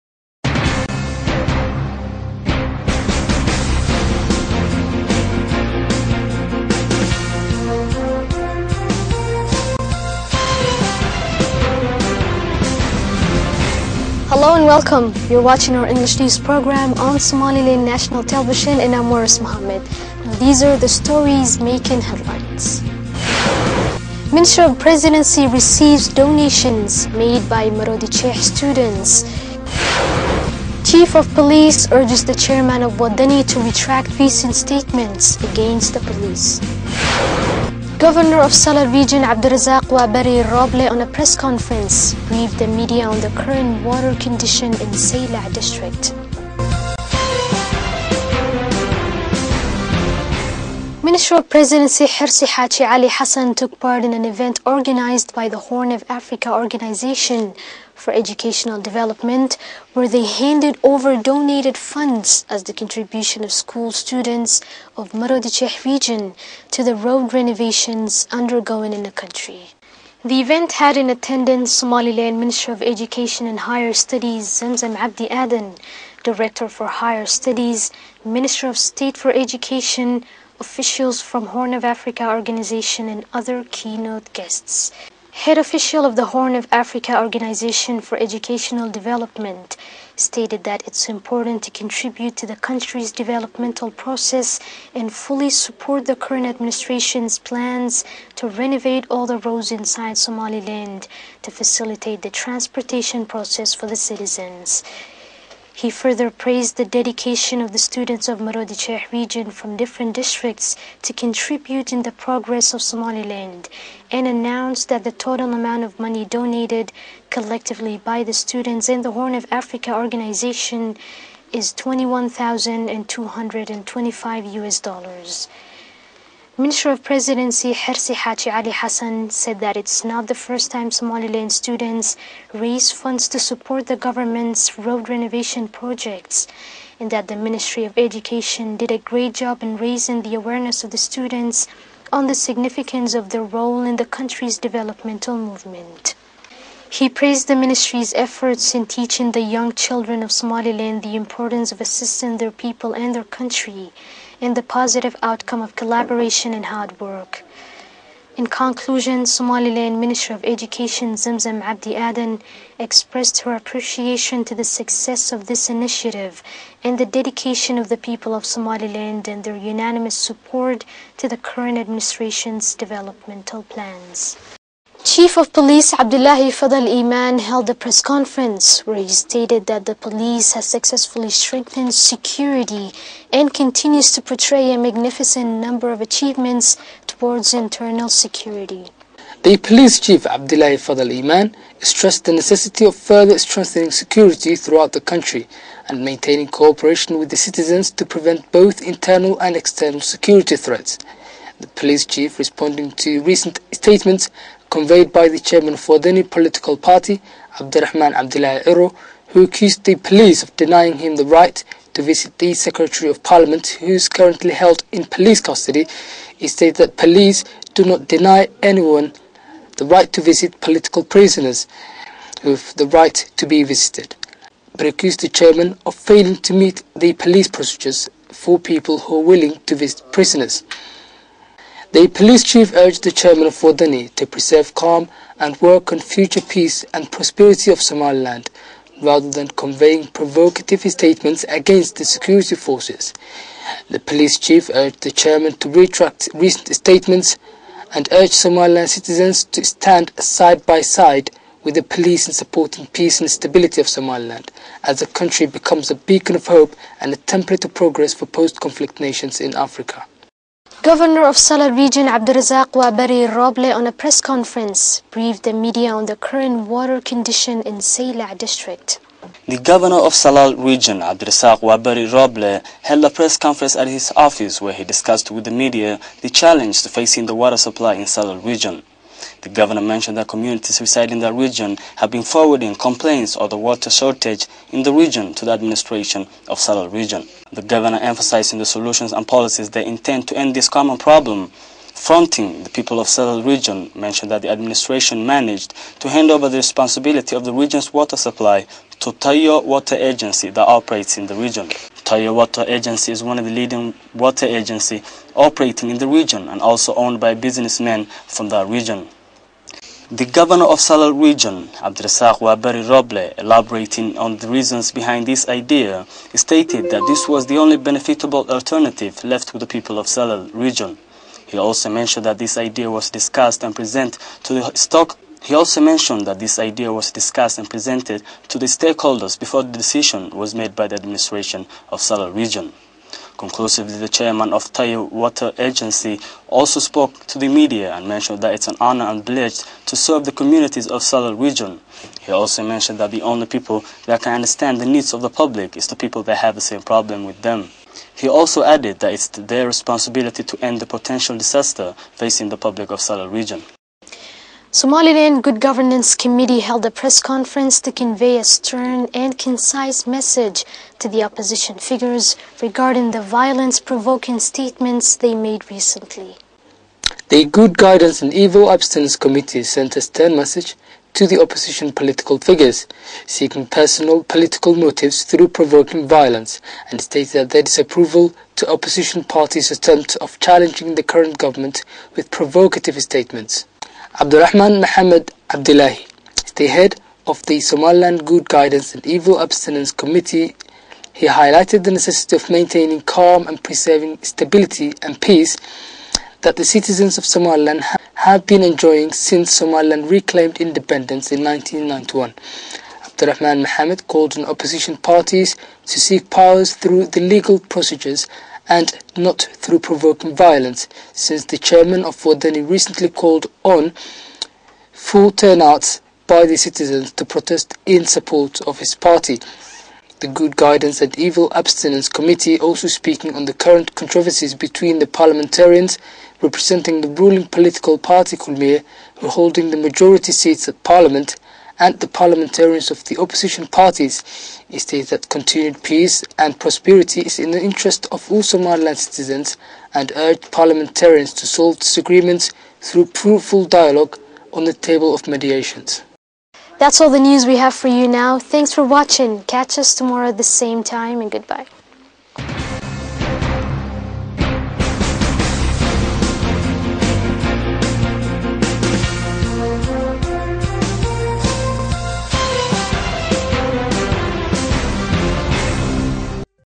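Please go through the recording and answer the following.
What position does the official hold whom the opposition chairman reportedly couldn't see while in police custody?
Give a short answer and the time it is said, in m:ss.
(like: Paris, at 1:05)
Secretary of Parliament, at 3:32.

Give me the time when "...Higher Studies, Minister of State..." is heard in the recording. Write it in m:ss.
1:16.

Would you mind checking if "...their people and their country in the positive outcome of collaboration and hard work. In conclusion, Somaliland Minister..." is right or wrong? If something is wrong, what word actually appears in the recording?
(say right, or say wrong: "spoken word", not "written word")
right.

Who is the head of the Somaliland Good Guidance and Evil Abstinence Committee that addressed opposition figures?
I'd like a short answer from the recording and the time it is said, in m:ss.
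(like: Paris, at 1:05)
Abdurrahman Mohammed Abdullahi, at 6:24.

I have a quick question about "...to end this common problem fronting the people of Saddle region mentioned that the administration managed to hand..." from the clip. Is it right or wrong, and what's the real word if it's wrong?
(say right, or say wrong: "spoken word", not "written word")
right.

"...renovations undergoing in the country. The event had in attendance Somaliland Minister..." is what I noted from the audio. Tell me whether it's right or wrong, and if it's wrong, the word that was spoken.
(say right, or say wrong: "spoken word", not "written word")
right.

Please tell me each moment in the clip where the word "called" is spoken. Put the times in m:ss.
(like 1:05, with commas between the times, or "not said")
6:44, 6:53.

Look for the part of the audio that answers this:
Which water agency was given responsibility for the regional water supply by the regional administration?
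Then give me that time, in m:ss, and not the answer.
5:02.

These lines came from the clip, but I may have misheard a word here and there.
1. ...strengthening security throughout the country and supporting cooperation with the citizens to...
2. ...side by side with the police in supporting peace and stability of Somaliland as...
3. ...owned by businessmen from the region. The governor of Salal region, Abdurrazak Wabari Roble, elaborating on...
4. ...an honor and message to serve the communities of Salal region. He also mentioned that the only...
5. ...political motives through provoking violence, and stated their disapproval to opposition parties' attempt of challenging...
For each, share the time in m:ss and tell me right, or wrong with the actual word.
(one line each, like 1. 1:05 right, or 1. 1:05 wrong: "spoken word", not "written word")
1. 3:13 wrong: "maintaining", not "supporting"
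2. 4:10 right
3. 5:06 right
4. 5:38 wrong: "privilege", not "message"
5. 6:14 right.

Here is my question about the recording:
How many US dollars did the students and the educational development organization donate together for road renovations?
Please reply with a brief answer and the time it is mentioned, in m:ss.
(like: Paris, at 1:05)
21,225 US dollars, at 2:01.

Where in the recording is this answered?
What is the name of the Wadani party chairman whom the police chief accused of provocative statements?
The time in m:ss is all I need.
3:27.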